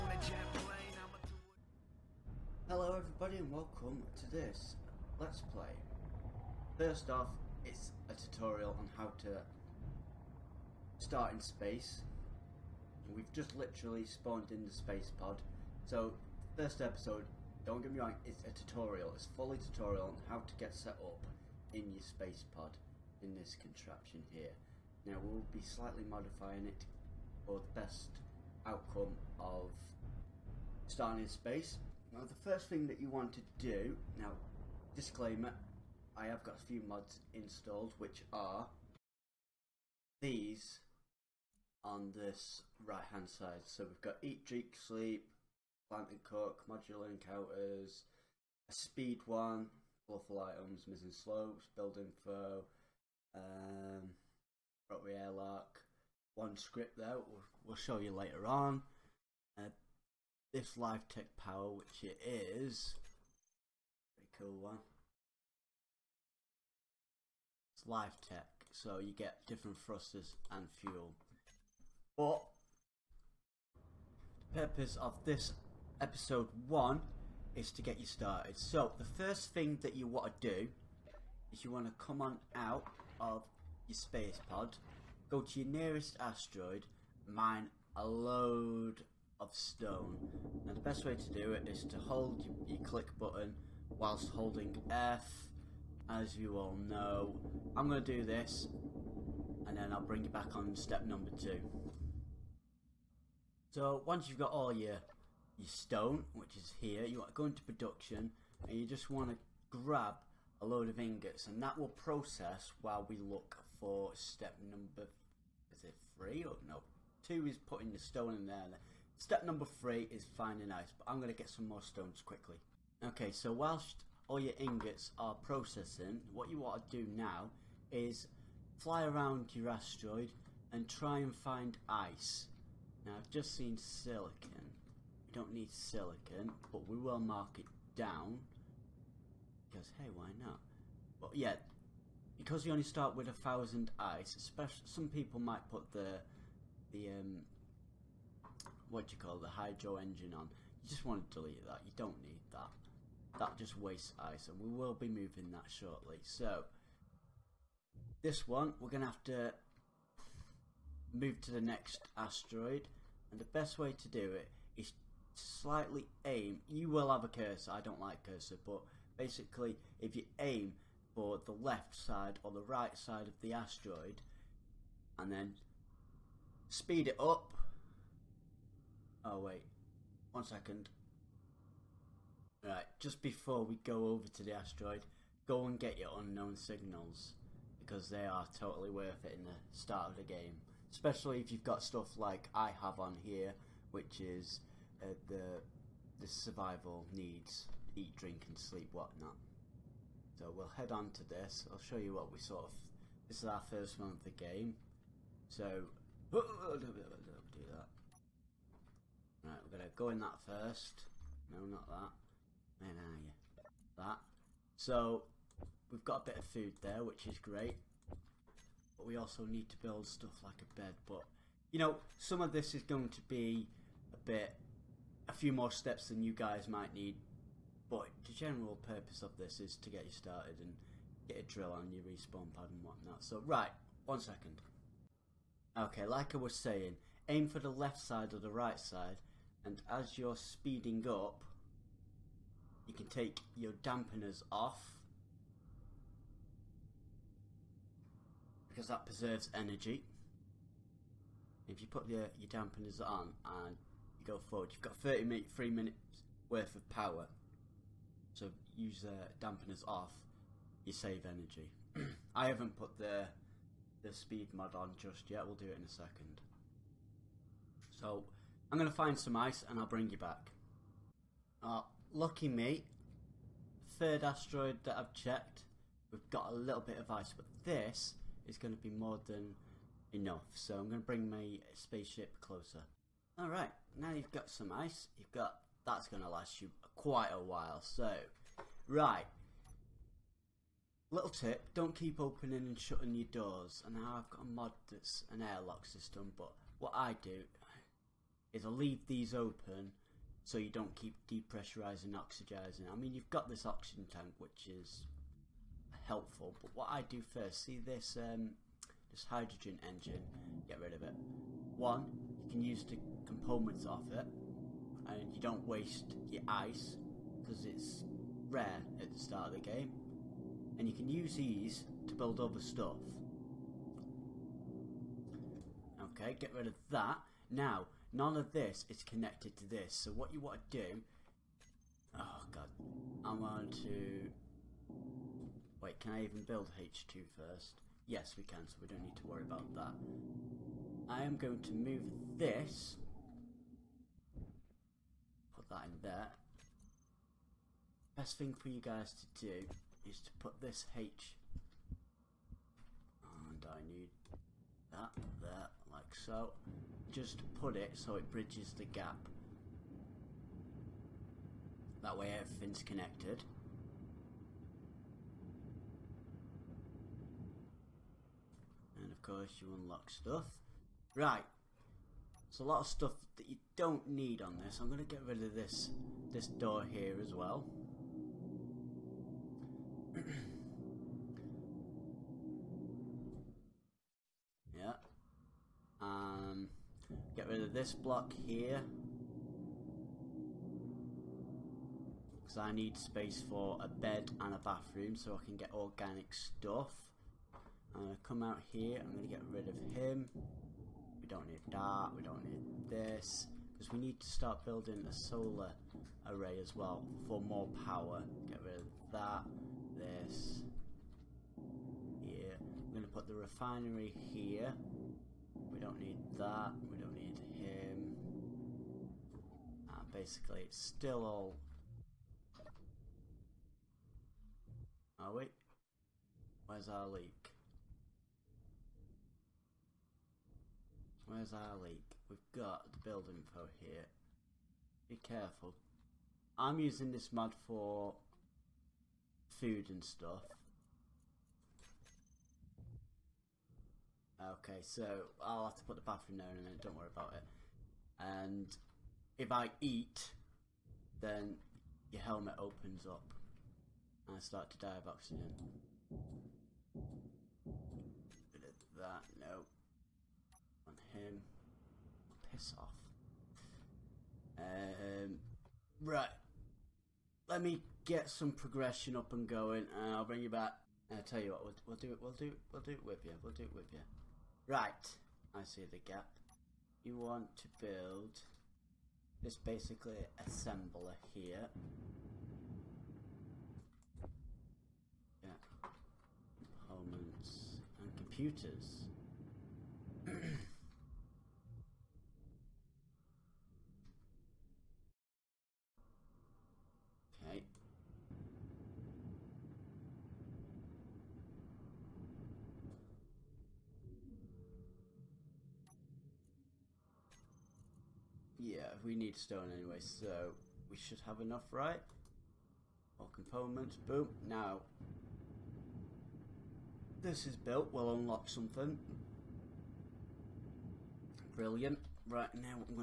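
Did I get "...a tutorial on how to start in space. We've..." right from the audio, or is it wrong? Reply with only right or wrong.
right.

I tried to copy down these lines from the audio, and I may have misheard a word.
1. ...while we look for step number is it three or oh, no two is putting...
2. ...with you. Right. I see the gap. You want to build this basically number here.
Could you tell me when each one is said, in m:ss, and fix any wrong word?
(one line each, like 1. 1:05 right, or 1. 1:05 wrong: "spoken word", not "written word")
1. 1:52 right
2. 7:53 wrong: "assembler", not "number".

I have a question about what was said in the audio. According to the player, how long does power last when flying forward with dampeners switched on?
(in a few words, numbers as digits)
3 minutes.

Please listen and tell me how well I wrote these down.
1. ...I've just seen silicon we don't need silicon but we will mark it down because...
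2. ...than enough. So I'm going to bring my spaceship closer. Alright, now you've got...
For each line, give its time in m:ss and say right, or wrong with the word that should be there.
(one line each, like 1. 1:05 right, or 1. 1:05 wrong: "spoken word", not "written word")
1. 2:13 right
2. 4:39 right.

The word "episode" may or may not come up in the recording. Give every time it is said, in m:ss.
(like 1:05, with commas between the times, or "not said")
0:16, 1:16.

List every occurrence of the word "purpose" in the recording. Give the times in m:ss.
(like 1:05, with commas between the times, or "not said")
1:14, 3:48.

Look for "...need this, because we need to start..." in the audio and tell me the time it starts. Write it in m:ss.
6:42.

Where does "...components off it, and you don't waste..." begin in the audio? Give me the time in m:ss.
5:13.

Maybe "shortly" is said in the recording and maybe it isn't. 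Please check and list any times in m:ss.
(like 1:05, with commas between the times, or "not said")
2:35.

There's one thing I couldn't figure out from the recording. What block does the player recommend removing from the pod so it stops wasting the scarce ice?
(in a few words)
Hydrogen engine.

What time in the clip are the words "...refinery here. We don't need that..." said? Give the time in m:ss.
6:53.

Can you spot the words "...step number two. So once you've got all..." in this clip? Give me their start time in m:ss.
1:40.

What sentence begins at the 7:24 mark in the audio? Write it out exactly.
Okay, so I'll have to put the bathroom there in a minute, don't worry about it.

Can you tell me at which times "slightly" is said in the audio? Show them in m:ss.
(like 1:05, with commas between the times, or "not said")
0:25, 2:45.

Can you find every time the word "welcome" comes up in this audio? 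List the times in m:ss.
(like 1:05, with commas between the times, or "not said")
0:03.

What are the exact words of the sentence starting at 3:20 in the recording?
So we'll head on to this.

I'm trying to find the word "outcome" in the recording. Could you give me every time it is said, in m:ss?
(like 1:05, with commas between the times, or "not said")
0:28.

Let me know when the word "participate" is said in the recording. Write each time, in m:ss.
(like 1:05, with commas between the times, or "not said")
not said.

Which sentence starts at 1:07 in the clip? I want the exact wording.
It's Live Tech, so you get different thrusters and fuel.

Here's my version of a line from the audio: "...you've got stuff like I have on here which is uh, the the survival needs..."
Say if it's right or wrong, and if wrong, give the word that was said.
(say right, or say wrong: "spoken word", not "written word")
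right.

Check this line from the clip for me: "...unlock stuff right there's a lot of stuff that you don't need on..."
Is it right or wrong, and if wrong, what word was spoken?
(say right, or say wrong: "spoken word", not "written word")
right.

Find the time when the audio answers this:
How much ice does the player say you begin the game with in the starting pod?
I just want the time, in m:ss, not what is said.
2:23.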